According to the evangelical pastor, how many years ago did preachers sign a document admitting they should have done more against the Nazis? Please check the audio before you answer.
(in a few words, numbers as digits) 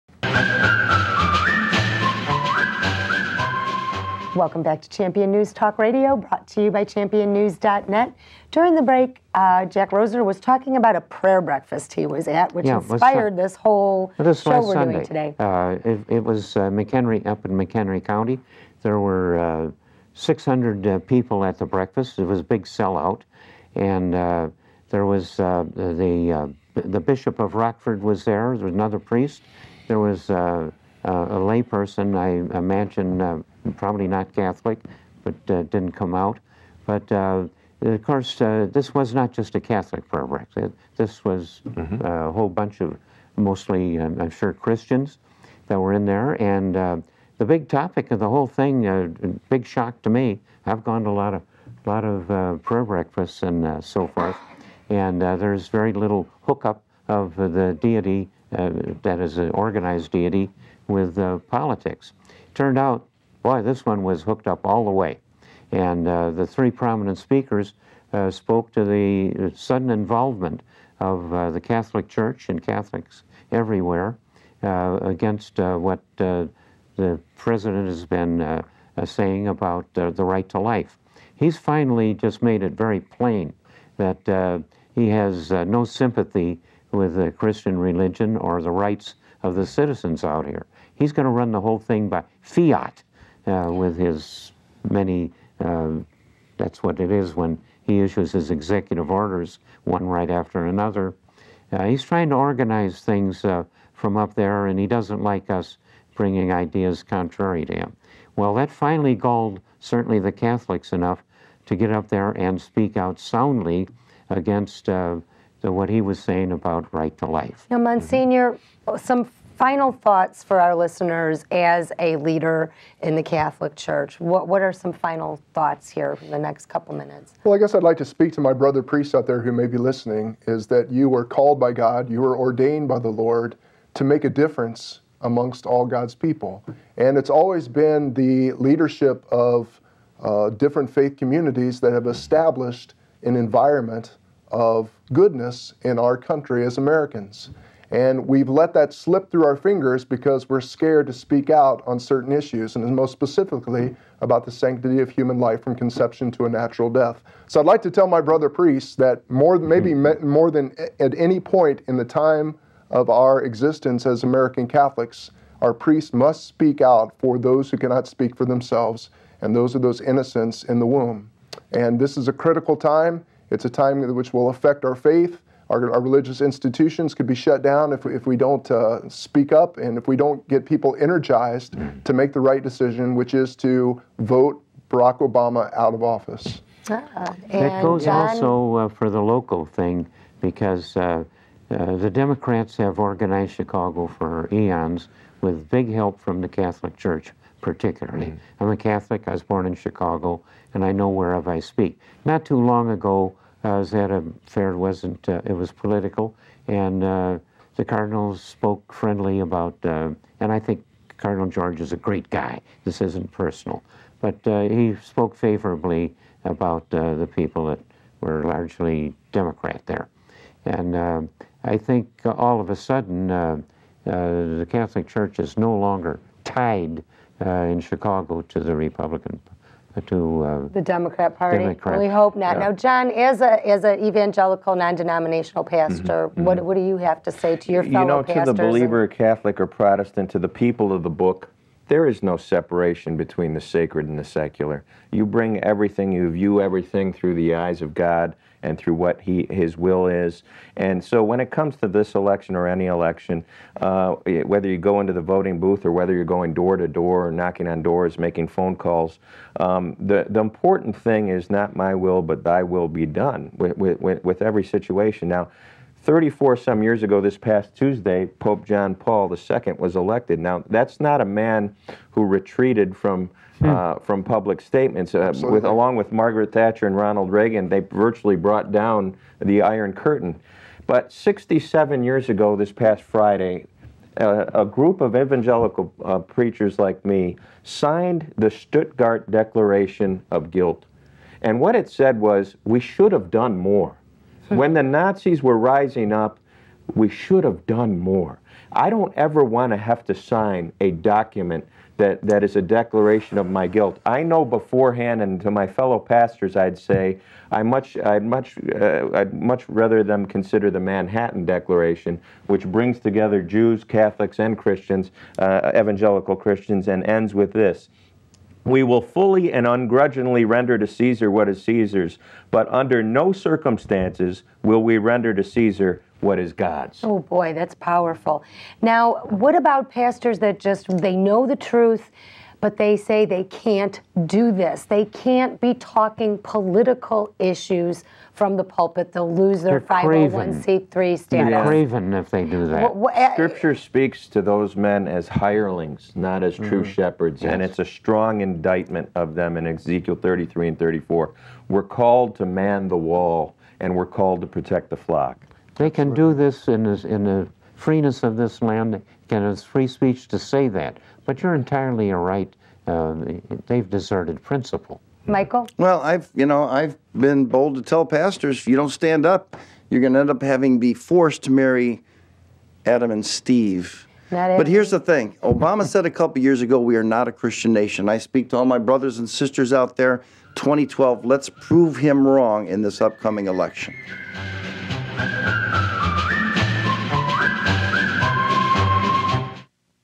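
67.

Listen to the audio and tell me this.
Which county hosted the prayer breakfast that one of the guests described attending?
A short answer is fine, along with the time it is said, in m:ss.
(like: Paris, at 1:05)
McHenry County, at 0:17.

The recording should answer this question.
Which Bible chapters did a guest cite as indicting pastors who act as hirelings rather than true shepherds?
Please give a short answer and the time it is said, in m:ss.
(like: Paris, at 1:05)
Ezekiel 33 and 34, at 5:49.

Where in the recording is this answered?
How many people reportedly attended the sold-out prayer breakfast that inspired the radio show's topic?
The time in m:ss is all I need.
0:20.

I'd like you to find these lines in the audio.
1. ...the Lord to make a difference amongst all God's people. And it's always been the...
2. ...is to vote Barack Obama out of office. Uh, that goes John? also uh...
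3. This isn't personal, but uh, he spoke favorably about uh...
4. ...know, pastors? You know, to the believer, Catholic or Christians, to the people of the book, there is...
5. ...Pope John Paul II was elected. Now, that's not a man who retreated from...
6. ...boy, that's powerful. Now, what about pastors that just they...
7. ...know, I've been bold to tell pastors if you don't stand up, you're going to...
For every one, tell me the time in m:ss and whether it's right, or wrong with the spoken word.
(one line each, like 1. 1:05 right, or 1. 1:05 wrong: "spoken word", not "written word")
1. 2:12 right
2. 3:03 right
3. 3:32 right
4. 3:58 wrong: "Protestant", not "Christians"
5. 4:28 right
6. 5:27 right
7. 6:06 right.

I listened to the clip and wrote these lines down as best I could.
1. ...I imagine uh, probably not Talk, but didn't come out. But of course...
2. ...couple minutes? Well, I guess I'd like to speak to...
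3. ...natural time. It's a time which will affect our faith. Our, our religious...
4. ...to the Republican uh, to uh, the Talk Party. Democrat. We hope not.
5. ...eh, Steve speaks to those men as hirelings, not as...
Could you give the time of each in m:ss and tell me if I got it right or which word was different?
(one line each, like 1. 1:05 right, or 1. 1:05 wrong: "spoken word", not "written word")
1. 0:32 wrong: "Catholic", not "Talk"
2. 2:06 right
3. 2:52 wrong: "critical", not "natural"
4. 3:48 wrong: "Democrat", not "Talk"
5. 5:43 wrong: "Scripture", not "Steve".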